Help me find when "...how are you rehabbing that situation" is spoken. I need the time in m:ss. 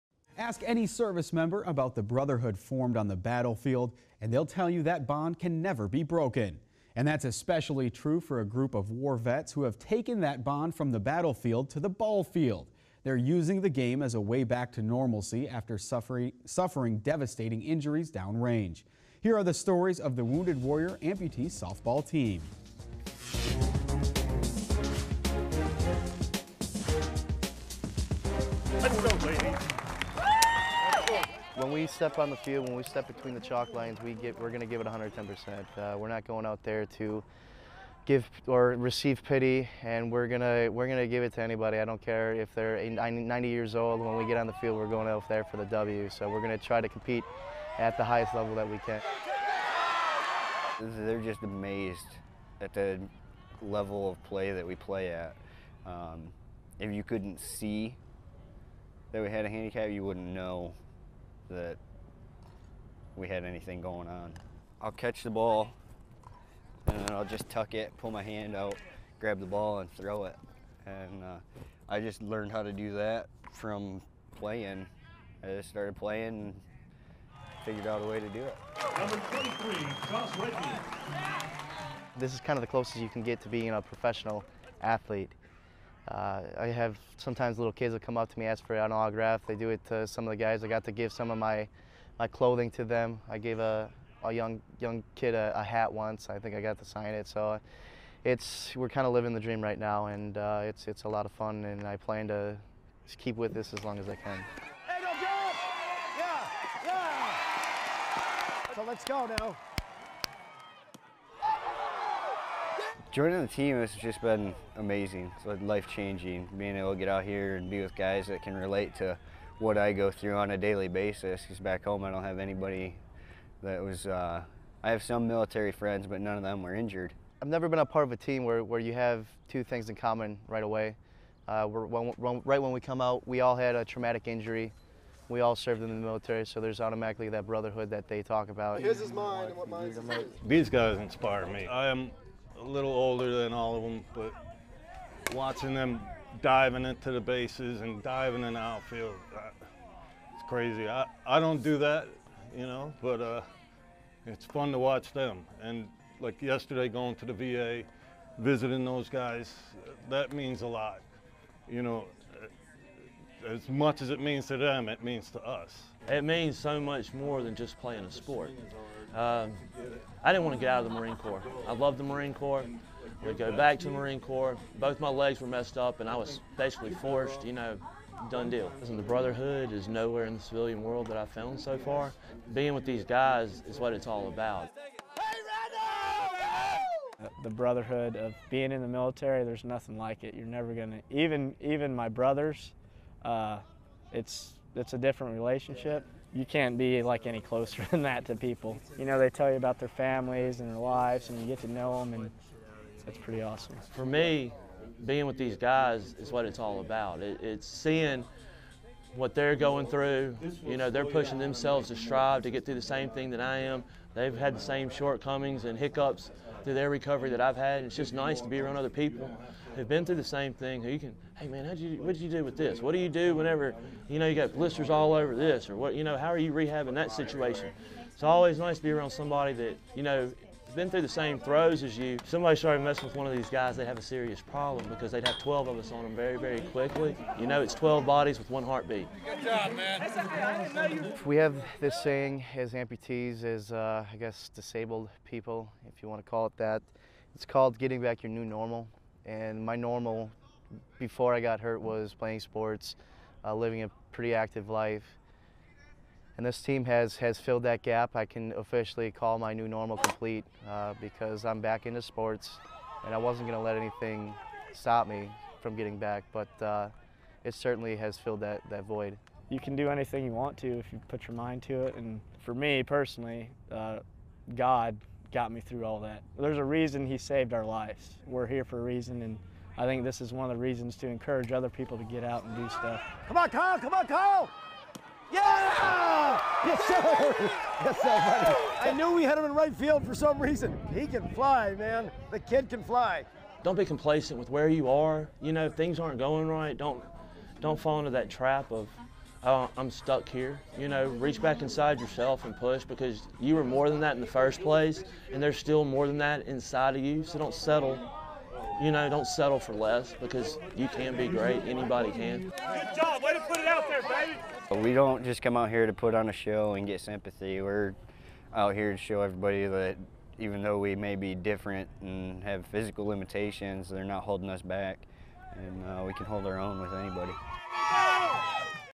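3:46.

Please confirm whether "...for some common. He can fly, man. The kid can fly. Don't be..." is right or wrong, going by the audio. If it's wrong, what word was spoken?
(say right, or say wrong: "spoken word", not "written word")
wrong: "reason", not "common".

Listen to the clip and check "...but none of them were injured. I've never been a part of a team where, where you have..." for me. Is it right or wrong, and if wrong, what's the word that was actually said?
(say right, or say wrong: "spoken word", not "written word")
right.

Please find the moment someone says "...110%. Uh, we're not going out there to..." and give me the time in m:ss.
0:34.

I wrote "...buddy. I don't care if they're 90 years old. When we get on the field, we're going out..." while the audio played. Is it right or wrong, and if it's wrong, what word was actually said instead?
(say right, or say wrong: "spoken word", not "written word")
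wrong: "anybody", not "buddy".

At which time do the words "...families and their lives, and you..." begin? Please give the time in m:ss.
3:19.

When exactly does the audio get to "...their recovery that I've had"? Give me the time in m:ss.
3:36.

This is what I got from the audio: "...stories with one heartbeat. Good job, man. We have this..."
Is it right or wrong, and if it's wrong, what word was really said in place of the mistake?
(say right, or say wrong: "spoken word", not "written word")
wrong: "bodies", not "stories".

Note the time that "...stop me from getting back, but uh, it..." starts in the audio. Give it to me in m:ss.
4:24.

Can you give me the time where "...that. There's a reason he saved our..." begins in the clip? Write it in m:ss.
4:35.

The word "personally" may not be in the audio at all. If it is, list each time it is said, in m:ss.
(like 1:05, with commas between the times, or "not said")
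4:32.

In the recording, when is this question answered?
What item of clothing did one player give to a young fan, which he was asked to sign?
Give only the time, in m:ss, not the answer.
1:35.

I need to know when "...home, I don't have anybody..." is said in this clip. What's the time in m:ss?
2:01.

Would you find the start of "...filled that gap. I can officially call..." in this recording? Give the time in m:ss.
4:17.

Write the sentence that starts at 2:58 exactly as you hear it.
Listen, the brotherhood is nowhere in the civilian world that I've found so far.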